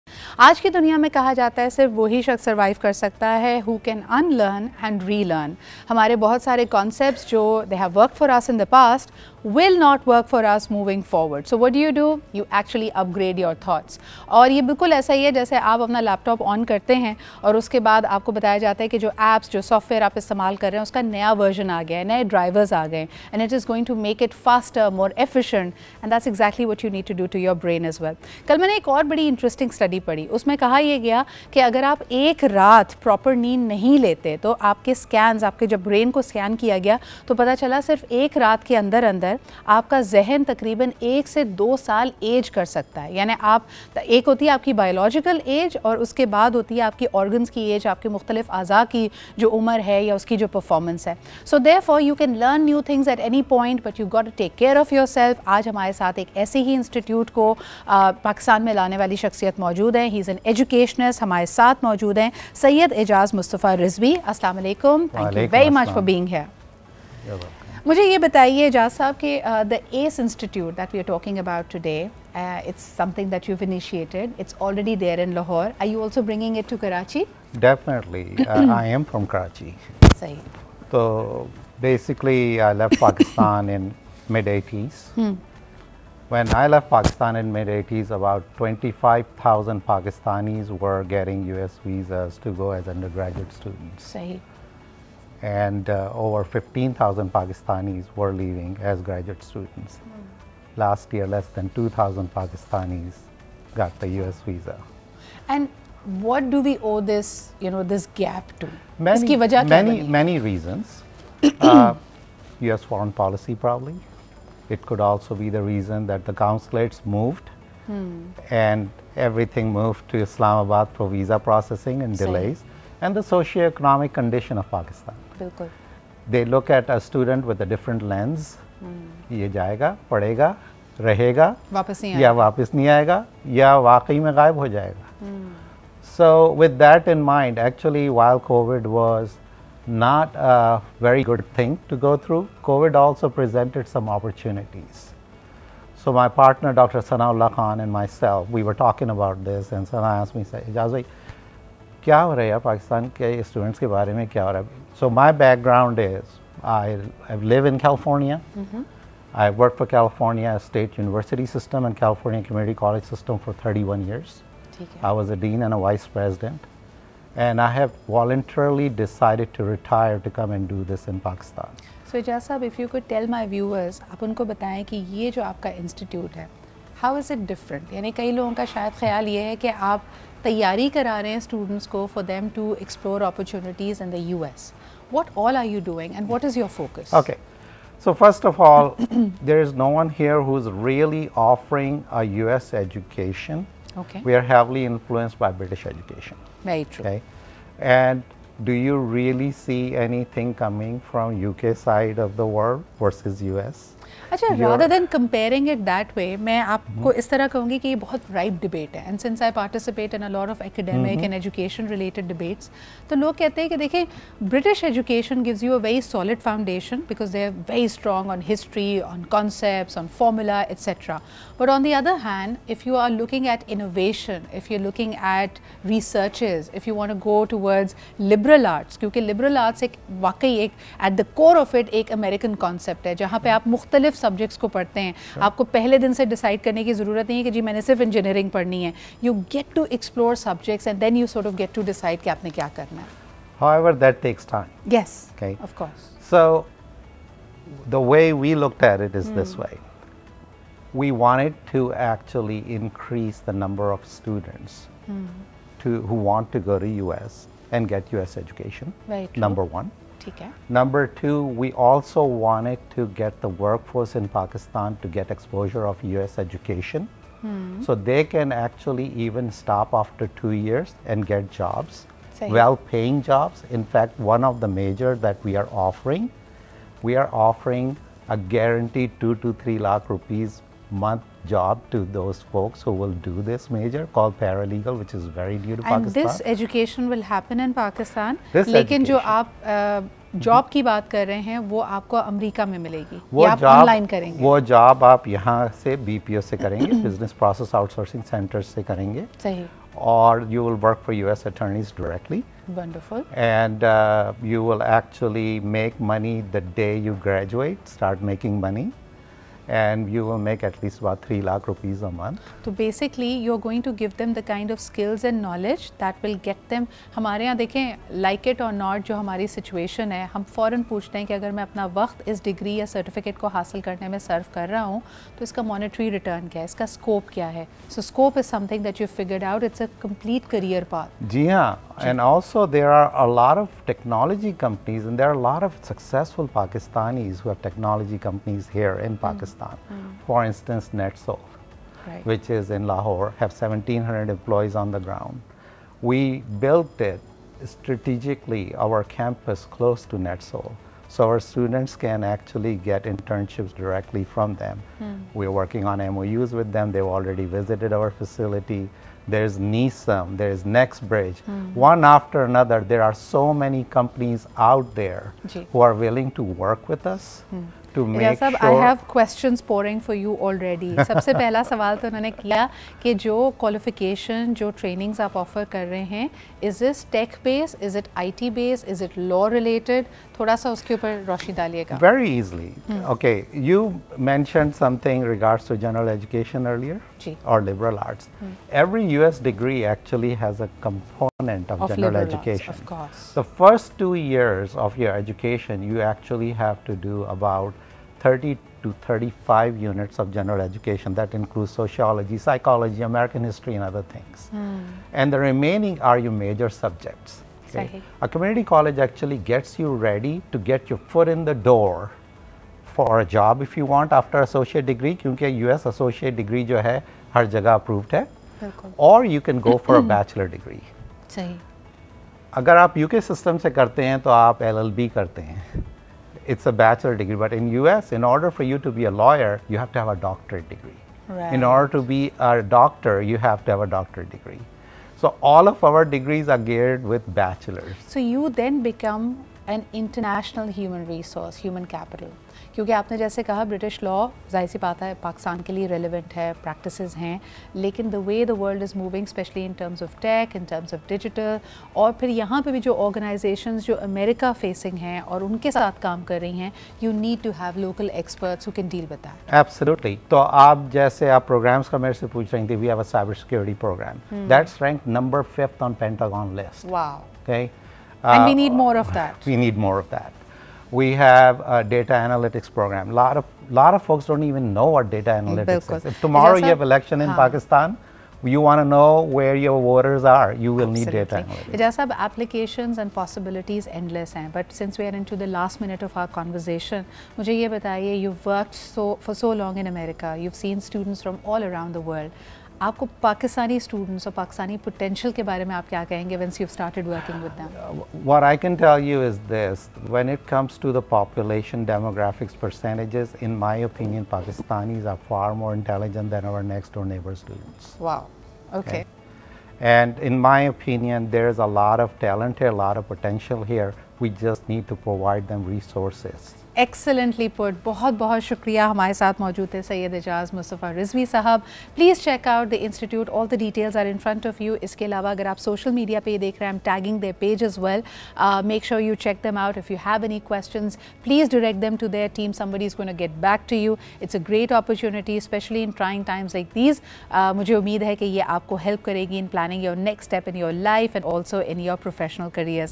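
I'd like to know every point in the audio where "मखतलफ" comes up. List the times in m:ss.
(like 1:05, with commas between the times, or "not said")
0:48, 3:53.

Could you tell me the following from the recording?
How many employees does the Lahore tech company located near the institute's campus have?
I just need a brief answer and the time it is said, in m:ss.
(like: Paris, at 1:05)
1,700, at 5:43.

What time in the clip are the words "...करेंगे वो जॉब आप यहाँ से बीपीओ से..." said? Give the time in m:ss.
4:54.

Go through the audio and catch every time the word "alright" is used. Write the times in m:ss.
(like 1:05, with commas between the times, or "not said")
not said.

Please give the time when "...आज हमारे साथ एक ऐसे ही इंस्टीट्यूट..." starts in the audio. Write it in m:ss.
0:55.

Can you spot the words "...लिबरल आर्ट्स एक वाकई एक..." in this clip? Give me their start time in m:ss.
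3:49.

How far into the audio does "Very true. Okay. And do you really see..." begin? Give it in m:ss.
3:16.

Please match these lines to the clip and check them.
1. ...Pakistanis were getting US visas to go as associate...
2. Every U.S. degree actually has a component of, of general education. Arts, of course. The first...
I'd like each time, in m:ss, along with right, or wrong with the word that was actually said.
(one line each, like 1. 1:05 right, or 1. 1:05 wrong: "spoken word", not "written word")
1. 1:29 wrong: "undergraduate", not "associate"
2. 6:28 right.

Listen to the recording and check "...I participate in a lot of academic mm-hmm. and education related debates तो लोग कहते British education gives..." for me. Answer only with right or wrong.
right.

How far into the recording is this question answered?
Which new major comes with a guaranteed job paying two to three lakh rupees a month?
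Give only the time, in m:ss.
4:44.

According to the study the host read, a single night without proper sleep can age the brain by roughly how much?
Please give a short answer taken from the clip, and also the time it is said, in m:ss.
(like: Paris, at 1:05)
1 to 2 years, at 0:41.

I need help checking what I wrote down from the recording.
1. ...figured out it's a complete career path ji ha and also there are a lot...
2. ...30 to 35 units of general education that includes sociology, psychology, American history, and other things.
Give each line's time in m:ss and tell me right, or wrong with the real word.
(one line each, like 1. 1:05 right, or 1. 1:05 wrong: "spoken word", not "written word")
1. 5:29 right
2. 6:38 right.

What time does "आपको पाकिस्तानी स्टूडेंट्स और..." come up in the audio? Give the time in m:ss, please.
8:12.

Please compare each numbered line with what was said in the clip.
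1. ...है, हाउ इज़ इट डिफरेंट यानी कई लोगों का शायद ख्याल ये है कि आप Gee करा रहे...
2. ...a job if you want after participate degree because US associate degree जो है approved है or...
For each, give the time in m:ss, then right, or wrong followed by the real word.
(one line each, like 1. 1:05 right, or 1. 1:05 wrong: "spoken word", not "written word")
1. 2:56 wrong: "The", not "Gee"
2. 6:53 wrong: "associate", not "participate".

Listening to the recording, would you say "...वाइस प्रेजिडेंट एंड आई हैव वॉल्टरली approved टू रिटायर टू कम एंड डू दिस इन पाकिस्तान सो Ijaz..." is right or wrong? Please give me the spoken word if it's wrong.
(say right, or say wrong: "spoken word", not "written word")
wrong: "decided", not "approved".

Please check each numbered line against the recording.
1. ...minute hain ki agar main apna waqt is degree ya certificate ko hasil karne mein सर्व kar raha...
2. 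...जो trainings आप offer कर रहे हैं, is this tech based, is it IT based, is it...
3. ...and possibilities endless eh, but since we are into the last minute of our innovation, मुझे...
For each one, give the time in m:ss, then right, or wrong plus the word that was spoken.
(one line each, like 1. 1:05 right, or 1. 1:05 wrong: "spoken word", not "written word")
1. 5:20 wrong: "poochte", not "minute"
2. 6:14 right
3. 8:02 wrong: "conversation", not "innovation".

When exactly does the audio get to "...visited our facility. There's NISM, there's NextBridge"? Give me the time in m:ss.
5:57.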